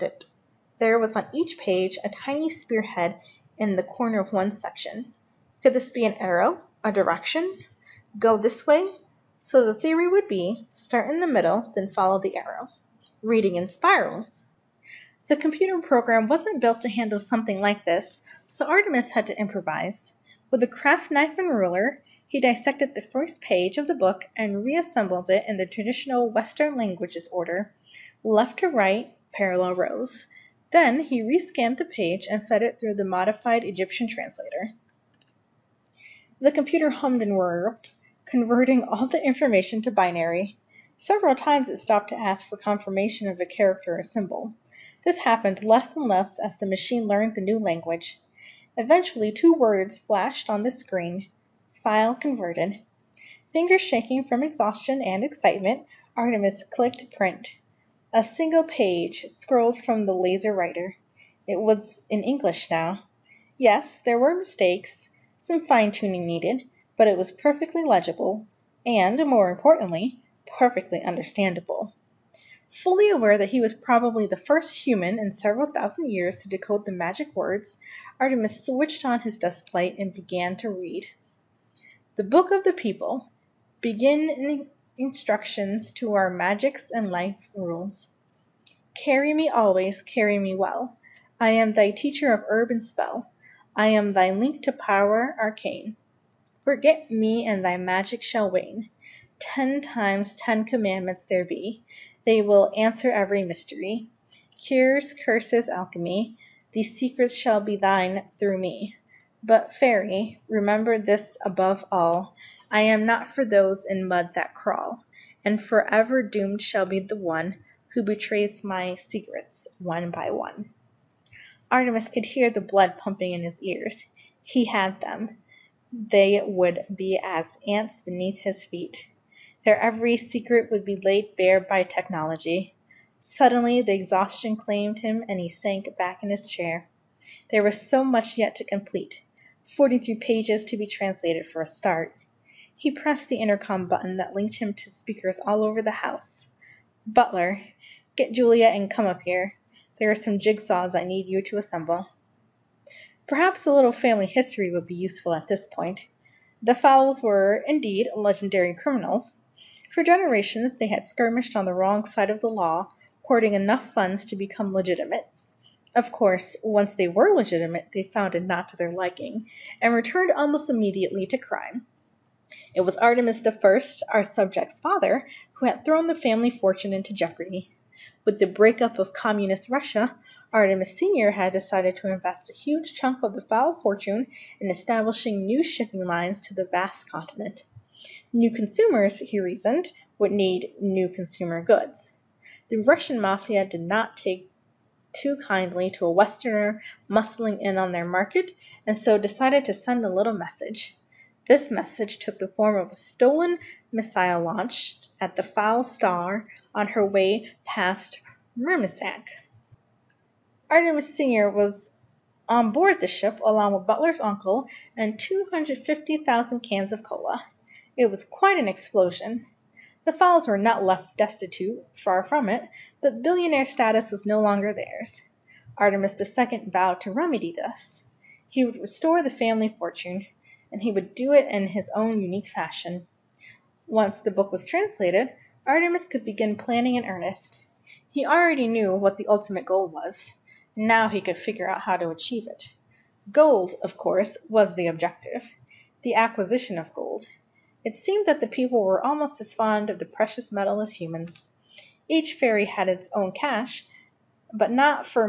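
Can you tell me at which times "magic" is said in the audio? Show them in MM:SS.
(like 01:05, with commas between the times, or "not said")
01:16, 01:26, 01:37.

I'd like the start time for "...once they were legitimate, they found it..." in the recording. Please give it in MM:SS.
02:46.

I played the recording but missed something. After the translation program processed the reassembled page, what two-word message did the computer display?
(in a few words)
file converted.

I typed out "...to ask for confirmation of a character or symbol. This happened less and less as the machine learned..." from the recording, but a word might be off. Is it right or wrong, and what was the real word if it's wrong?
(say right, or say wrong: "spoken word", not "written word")
right.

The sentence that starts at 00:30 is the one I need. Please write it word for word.
Then he rescanned the page and fed it through the modified Egyptian translator.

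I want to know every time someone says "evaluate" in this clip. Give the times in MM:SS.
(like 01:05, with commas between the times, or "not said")
not said.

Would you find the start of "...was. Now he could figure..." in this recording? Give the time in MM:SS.
03:59.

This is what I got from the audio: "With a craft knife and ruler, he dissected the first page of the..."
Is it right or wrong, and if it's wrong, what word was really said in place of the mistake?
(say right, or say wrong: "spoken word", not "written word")
right.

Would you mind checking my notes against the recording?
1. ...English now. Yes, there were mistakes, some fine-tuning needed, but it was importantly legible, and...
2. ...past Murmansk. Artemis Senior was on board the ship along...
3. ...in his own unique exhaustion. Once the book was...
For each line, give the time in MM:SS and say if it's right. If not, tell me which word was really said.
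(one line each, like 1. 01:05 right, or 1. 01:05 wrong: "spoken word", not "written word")
1. 01:02 wrong: "perfectly", not "importantly"
2. 03:27 right
3. 03:51 wrong: "fashion", not "exhaustion".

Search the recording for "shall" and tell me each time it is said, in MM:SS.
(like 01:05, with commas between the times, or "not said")
01:38, 01:47, 01:56.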